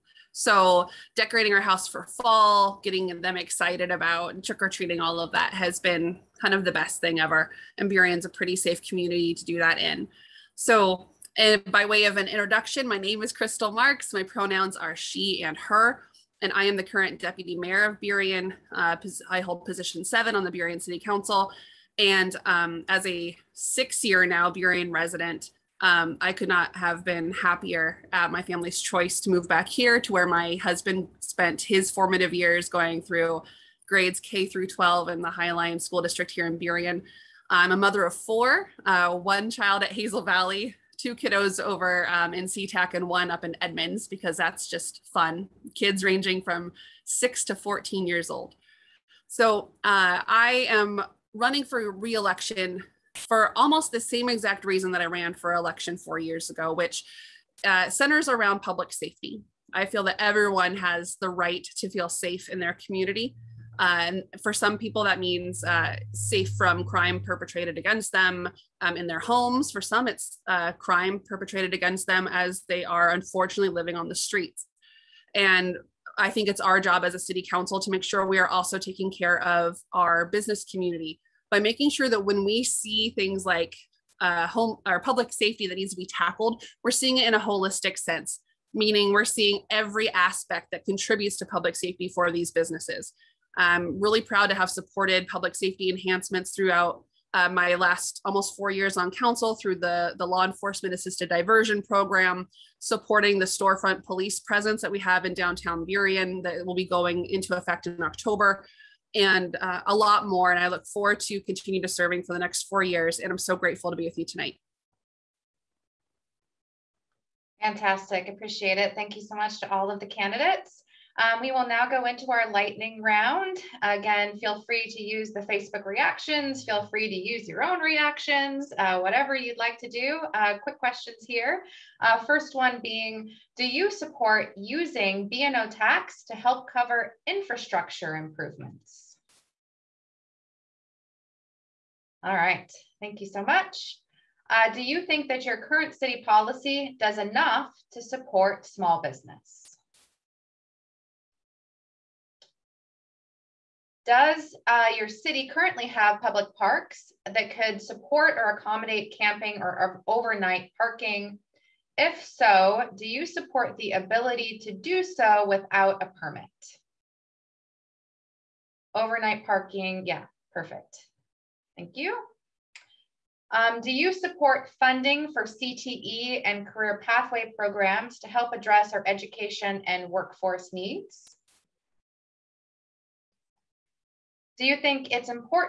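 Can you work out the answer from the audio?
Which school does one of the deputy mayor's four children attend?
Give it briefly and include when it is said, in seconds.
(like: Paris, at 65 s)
Hazel Valley, at 39 s.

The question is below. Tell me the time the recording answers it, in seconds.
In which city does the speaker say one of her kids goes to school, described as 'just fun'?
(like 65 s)
43 s.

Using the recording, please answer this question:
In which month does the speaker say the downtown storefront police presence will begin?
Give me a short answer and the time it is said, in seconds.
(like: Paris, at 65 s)
October, at 108 s.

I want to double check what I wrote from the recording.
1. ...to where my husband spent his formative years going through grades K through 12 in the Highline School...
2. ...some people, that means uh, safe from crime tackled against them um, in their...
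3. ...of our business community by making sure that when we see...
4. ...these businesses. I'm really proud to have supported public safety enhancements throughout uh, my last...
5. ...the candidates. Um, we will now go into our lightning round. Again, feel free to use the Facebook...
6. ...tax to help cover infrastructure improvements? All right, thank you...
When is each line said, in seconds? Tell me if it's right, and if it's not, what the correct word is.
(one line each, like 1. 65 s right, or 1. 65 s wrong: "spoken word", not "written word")
1. 29 s right
2. 64 s wrong: "perpetrated", not "tackled"
3. 79 s right
4. 92 s right
5. 119 s right
6. 135 s right.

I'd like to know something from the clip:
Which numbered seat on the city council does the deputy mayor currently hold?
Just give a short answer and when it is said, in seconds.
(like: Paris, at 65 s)
Position 7, at 19 s.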